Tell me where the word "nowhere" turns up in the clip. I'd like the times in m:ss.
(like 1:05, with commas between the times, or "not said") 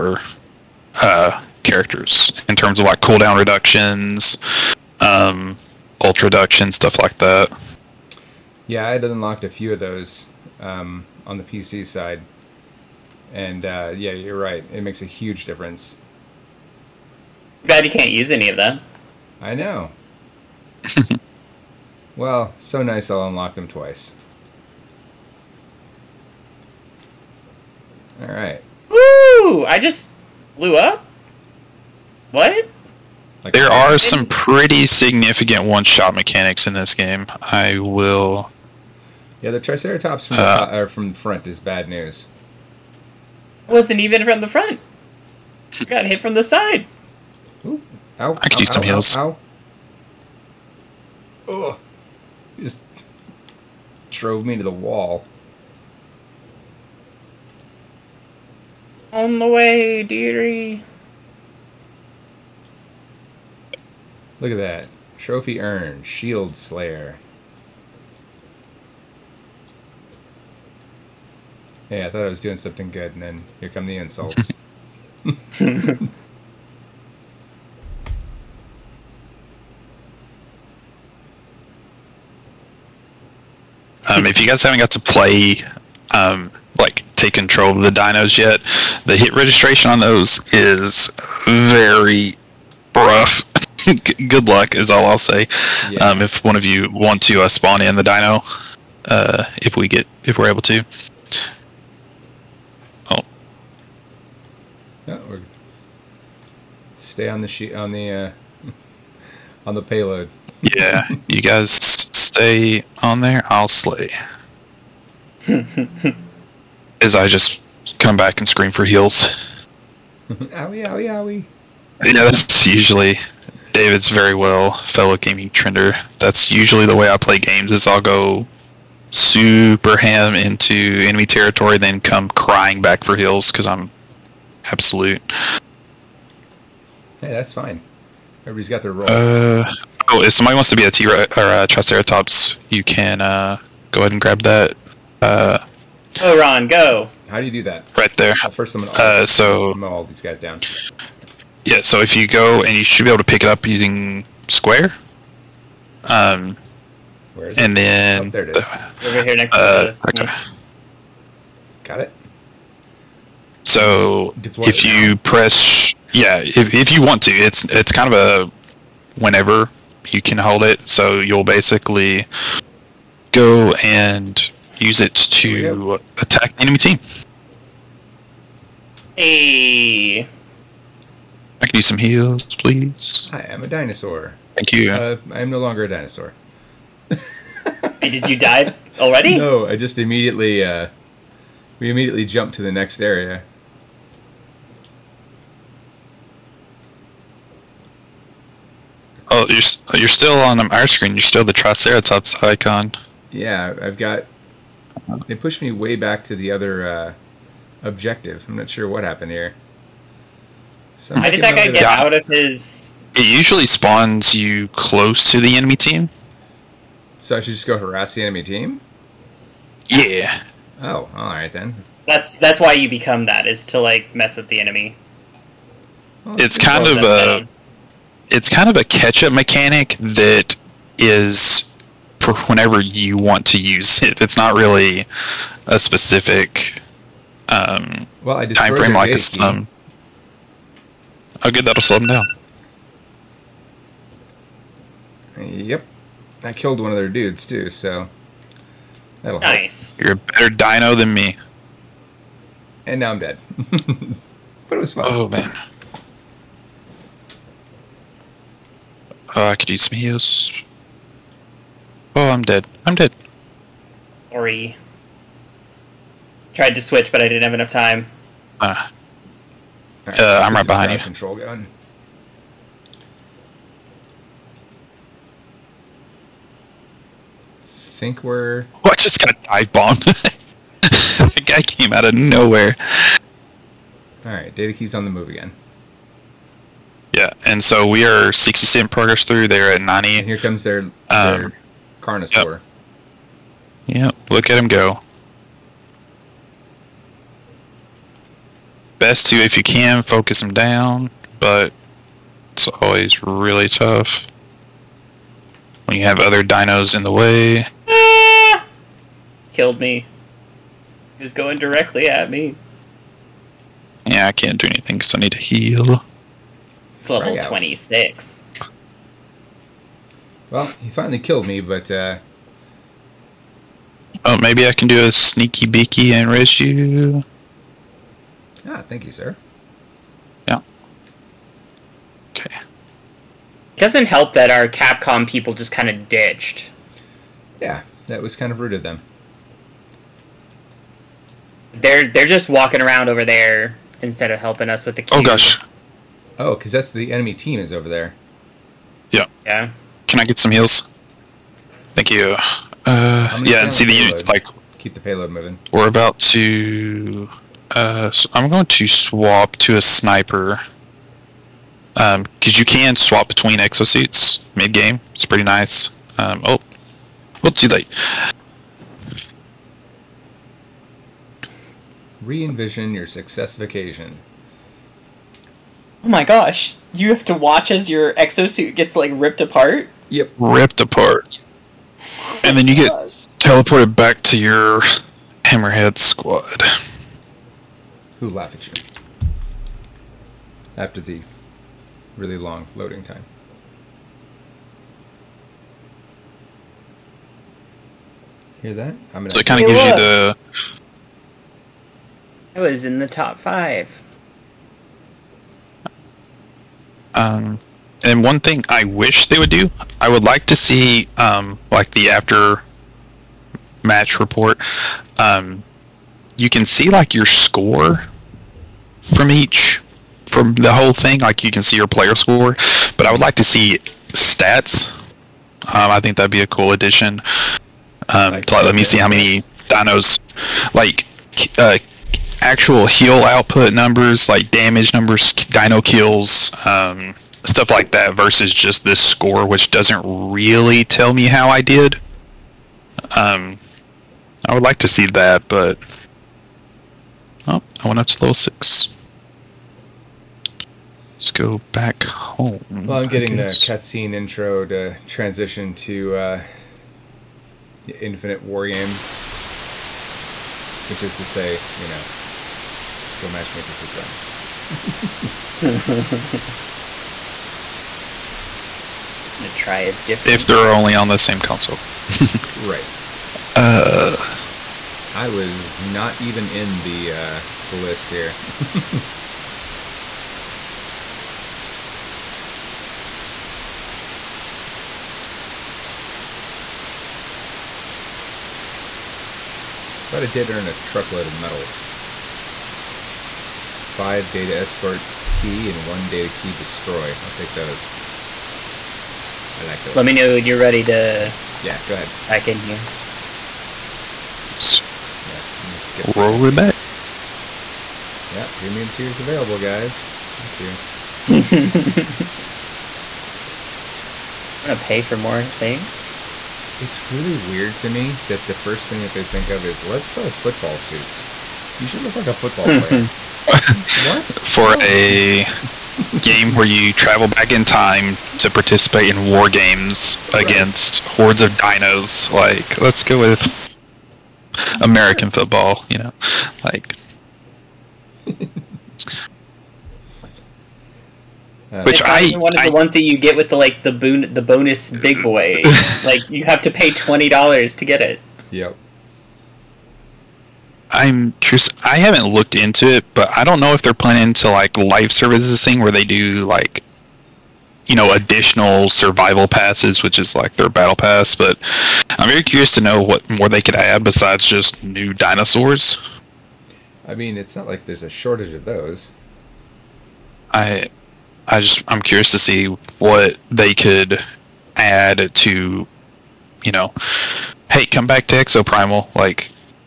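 4:42.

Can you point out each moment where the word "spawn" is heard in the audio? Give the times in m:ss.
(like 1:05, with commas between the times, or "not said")
1:37, 3:33.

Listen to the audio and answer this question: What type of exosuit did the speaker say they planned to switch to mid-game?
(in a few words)
Sniper.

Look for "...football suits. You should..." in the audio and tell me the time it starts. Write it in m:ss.
8:40.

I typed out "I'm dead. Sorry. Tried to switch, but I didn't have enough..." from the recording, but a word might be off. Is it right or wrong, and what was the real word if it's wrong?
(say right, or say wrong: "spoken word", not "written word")
right.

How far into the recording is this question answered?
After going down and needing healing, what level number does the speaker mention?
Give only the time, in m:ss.
5:17.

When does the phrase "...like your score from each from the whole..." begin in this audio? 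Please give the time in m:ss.
6:56.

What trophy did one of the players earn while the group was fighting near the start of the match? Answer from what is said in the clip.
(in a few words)
Shield Slayer.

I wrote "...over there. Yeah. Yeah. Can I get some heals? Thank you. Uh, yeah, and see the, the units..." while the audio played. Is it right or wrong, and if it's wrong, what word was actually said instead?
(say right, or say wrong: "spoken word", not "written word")
right.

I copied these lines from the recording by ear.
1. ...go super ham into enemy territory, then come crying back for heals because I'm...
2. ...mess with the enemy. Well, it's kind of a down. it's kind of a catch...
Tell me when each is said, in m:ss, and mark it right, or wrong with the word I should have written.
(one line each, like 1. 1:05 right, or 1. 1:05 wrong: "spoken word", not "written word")
1. 2:08 right
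2. 3:44 right.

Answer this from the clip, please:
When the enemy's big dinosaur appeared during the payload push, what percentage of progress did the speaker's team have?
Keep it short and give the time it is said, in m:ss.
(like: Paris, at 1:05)
60%, at 4:48.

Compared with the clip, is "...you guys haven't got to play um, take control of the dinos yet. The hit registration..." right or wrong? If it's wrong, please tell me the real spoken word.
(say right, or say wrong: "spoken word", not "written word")
right.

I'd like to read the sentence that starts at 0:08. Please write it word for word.
Yeah, I had unlocked a few of those um, on the PC side, and uh, yeah, you're right.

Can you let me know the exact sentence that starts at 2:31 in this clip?
Yeah, so if you go and you should be able to pick it up using square.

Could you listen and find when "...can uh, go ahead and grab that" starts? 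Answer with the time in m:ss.
2:22.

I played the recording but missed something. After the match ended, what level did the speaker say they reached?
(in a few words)
Level 6.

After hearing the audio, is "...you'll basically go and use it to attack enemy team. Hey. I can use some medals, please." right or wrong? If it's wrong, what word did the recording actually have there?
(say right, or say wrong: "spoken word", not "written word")
wrong: "heals", not "medals".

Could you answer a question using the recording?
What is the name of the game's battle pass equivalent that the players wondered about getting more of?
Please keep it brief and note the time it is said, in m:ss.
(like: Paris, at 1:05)
Survival passes, at 9:18.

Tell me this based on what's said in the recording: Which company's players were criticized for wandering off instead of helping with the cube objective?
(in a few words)
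Capcom.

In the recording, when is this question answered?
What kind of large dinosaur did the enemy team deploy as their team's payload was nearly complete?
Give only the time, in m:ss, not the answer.
4:52.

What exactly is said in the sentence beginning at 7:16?
Um, stuff like that versus just this score, which doesn't really tell me how I did.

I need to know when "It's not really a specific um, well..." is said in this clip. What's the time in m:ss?
3:54.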